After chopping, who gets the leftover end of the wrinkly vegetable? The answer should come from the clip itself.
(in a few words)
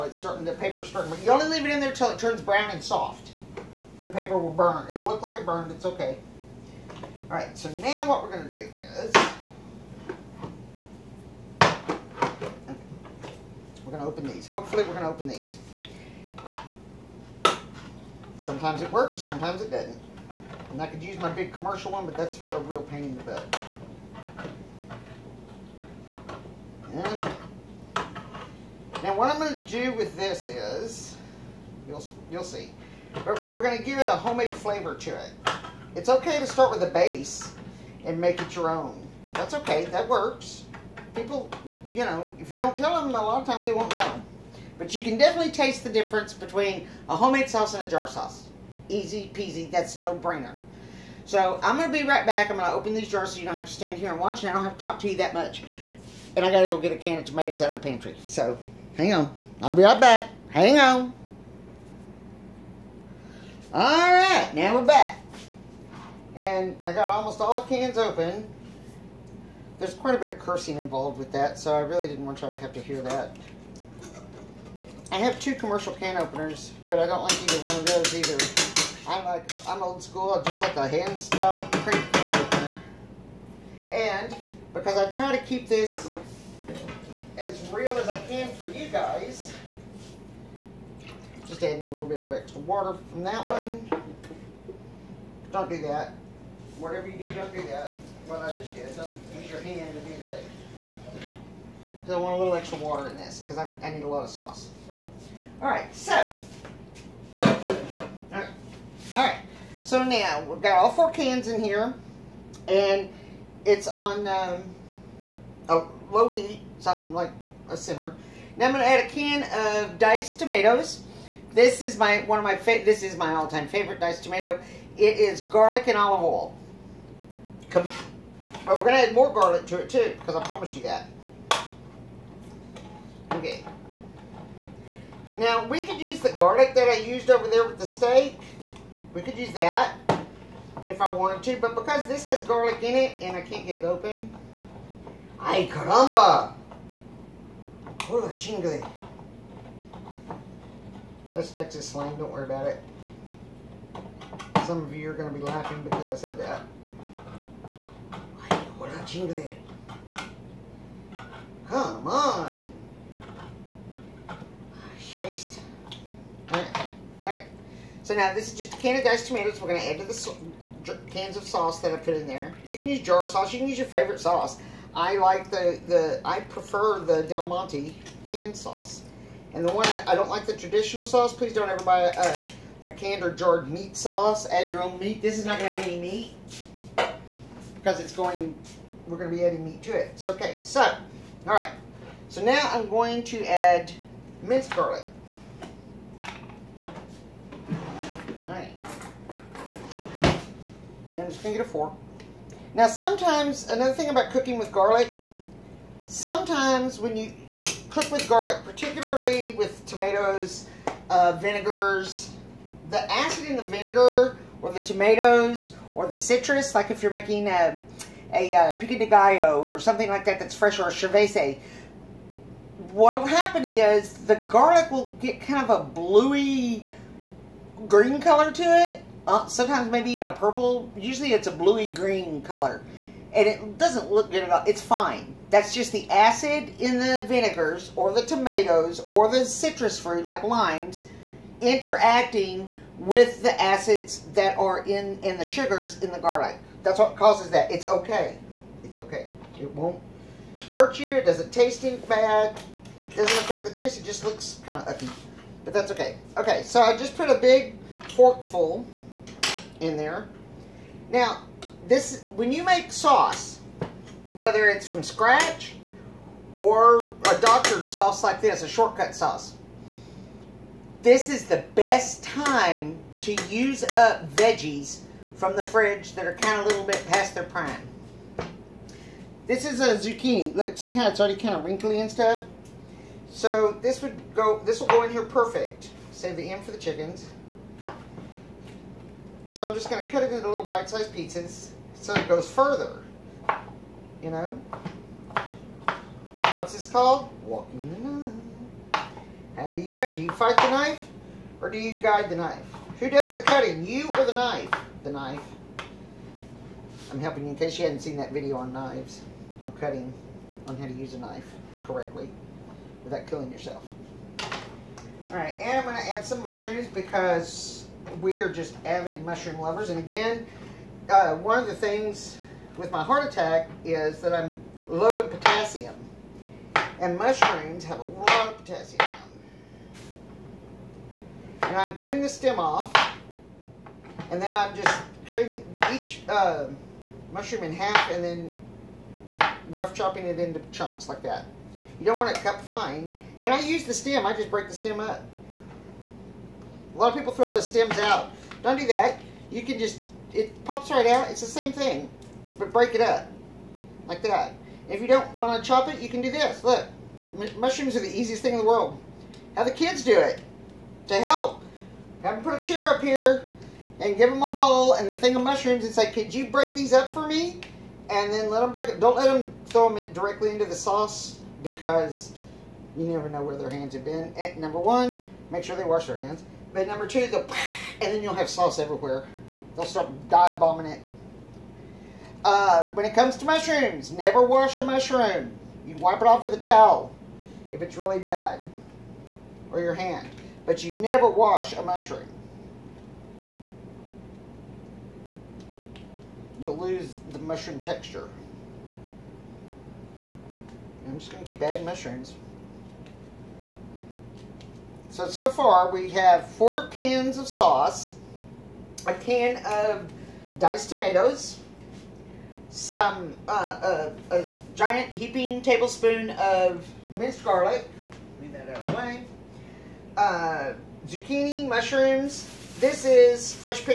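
the chickens.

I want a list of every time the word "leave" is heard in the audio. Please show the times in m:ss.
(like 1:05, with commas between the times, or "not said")
0:01, 6:58.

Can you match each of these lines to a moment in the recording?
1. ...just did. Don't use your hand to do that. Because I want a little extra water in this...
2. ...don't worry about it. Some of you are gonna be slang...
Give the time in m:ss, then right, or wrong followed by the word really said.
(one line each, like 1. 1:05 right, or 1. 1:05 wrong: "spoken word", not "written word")
1. 1:38 right
2. 2:32 wrong: "laughing", not "slang".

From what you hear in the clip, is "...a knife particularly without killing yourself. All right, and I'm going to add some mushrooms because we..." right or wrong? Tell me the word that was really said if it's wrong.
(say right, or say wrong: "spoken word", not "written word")
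wrong: "correctly", not "particularly".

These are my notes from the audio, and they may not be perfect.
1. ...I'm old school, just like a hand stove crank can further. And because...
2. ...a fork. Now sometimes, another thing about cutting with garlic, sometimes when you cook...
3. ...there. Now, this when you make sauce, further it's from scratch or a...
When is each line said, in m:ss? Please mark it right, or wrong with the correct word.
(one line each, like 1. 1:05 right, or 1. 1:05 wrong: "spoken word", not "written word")
1. 1:19 wrong: "opener", not "further"
2. 3:21 wrong: "cooking", not "cutting"
3. 4:19 wrong: "whether", not "further".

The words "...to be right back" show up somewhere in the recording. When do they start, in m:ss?
0:51.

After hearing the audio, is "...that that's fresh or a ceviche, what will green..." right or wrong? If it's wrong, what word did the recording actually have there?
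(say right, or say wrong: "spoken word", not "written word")
wrong: "happen", not "green".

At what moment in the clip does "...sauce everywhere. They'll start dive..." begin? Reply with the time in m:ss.
6:18.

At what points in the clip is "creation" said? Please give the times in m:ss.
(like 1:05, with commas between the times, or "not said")
not said.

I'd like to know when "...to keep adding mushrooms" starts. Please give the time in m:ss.
6:41.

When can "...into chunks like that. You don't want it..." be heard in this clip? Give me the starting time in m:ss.
5:40.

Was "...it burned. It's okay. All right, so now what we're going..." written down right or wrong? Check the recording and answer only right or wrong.
right.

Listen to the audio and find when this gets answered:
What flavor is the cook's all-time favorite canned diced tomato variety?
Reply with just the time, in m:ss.
2:05.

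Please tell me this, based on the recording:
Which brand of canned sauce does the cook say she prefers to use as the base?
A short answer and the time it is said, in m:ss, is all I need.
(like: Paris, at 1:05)
Del Monte, at 2:57.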